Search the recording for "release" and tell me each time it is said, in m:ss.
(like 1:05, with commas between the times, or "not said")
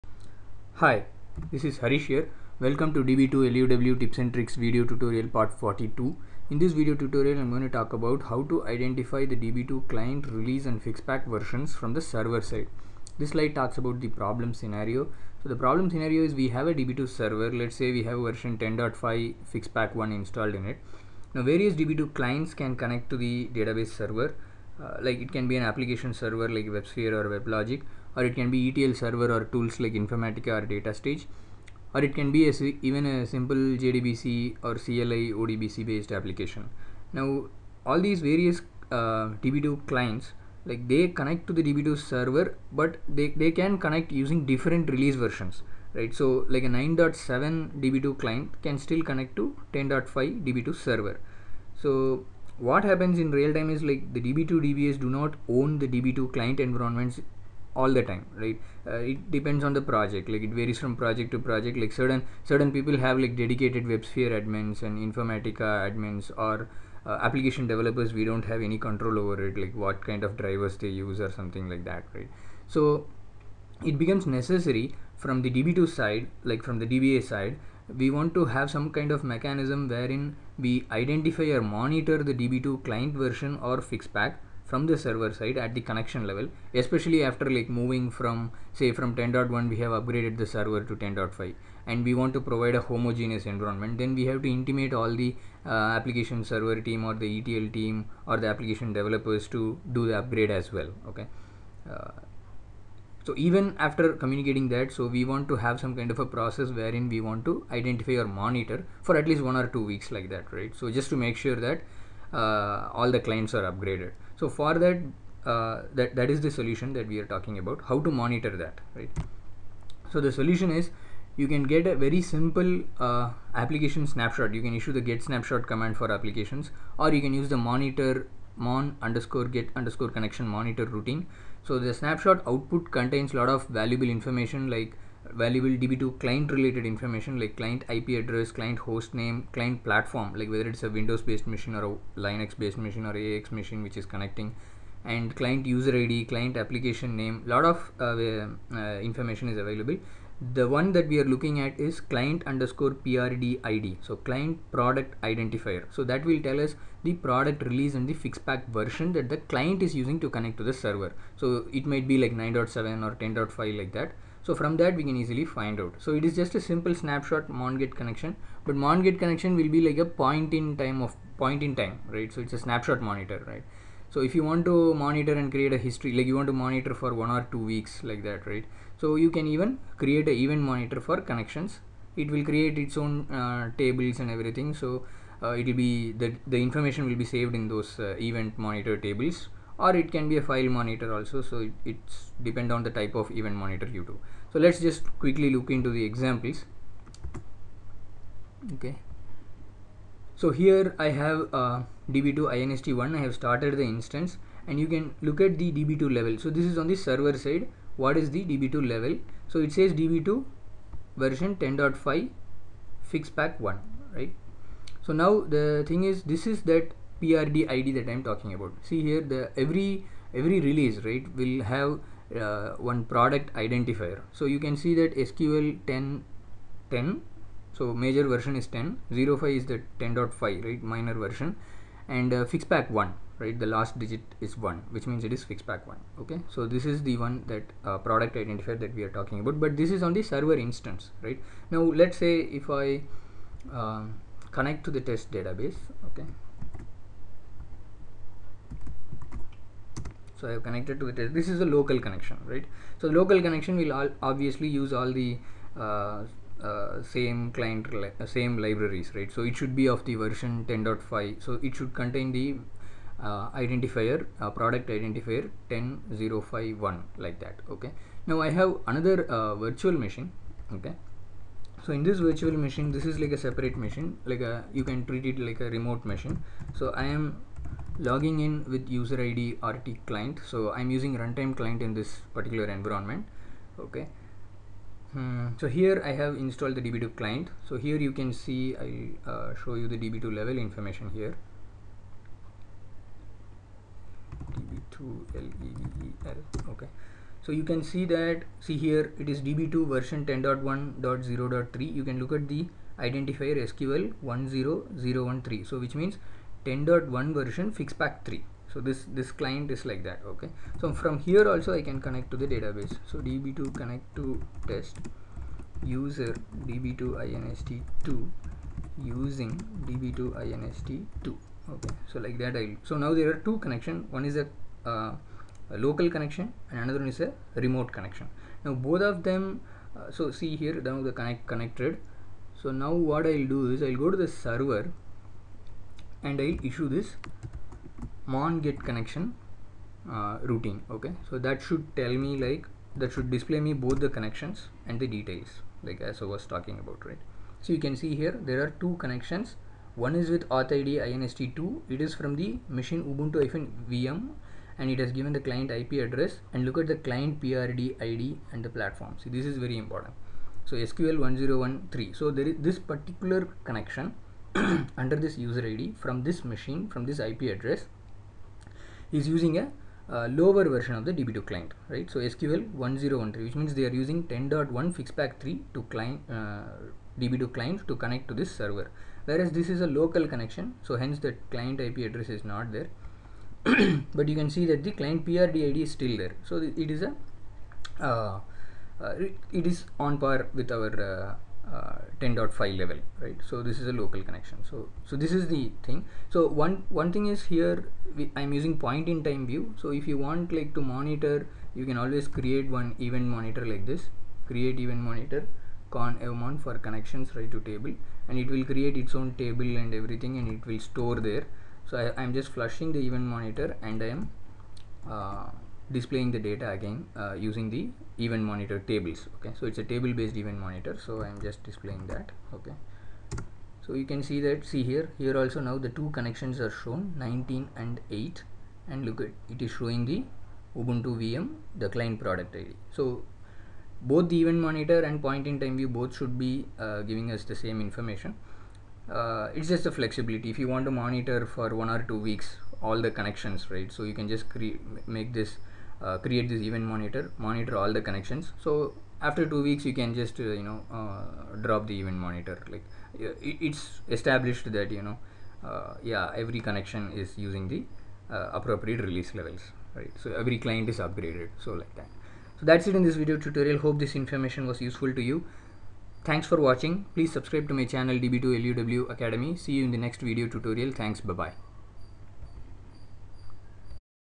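0:10, 0:44, 2:37, 3:40, 7:39.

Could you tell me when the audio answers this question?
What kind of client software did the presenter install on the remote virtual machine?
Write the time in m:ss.
4:41.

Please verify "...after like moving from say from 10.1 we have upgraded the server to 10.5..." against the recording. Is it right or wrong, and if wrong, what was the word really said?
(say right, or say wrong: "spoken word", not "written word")
right.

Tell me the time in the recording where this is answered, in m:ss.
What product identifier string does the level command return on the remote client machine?
5:03.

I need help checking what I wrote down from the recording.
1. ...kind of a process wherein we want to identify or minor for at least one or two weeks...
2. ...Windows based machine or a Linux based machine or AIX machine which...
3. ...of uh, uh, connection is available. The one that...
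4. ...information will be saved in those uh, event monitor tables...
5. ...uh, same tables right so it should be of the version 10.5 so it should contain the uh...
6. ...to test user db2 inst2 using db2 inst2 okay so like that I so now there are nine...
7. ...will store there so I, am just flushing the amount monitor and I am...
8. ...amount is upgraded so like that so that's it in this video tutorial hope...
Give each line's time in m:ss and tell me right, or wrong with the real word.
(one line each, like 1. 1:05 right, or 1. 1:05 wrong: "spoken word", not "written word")
1. 1:45 wrong: "monitor", not "minor"
2. 2:20 right
3. 2:27 wrong: "information", not "connection"
4. 3:06 right
5. 4:18 wrong: "libraries", not "tables"
6. 5:14 wrong: "two", not "nine"
7. 6:50 wrong: "event", not "amount"
8. 7:40 wrong: "client", not "amount".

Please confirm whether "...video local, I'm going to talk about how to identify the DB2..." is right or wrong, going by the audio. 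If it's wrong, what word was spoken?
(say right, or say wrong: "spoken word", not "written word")
wrong: "tutorial", not "local".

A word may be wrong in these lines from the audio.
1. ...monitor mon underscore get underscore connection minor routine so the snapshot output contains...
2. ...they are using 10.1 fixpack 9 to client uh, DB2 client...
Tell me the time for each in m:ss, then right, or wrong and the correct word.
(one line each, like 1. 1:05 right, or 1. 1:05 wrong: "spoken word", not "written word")
1. 2:07 wrong: "monitor", not "minor"
2. 6:13 wrong: "3", not "9".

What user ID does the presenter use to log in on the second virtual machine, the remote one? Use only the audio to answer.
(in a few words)
RT client.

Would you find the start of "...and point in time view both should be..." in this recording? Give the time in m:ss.
7:15.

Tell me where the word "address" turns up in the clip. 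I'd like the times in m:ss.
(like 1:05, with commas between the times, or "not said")
2:18, 5:56, 6:07, 6:21.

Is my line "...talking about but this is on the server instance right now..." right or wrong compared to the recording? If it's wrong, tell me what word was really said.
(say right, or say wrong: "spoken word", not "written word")
right.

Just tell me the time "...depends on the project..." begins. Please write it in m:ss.
0:59.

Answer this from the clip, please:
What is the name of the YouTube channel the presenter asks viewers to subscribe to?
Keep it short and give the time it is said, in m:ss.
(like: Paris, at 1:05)
db2luw academy, at 7:48.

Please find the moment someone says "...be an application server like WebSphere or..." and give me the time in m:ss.
0:25.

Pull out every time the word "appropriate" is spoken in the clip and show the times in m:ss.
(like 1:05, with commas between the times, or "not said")
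7:38.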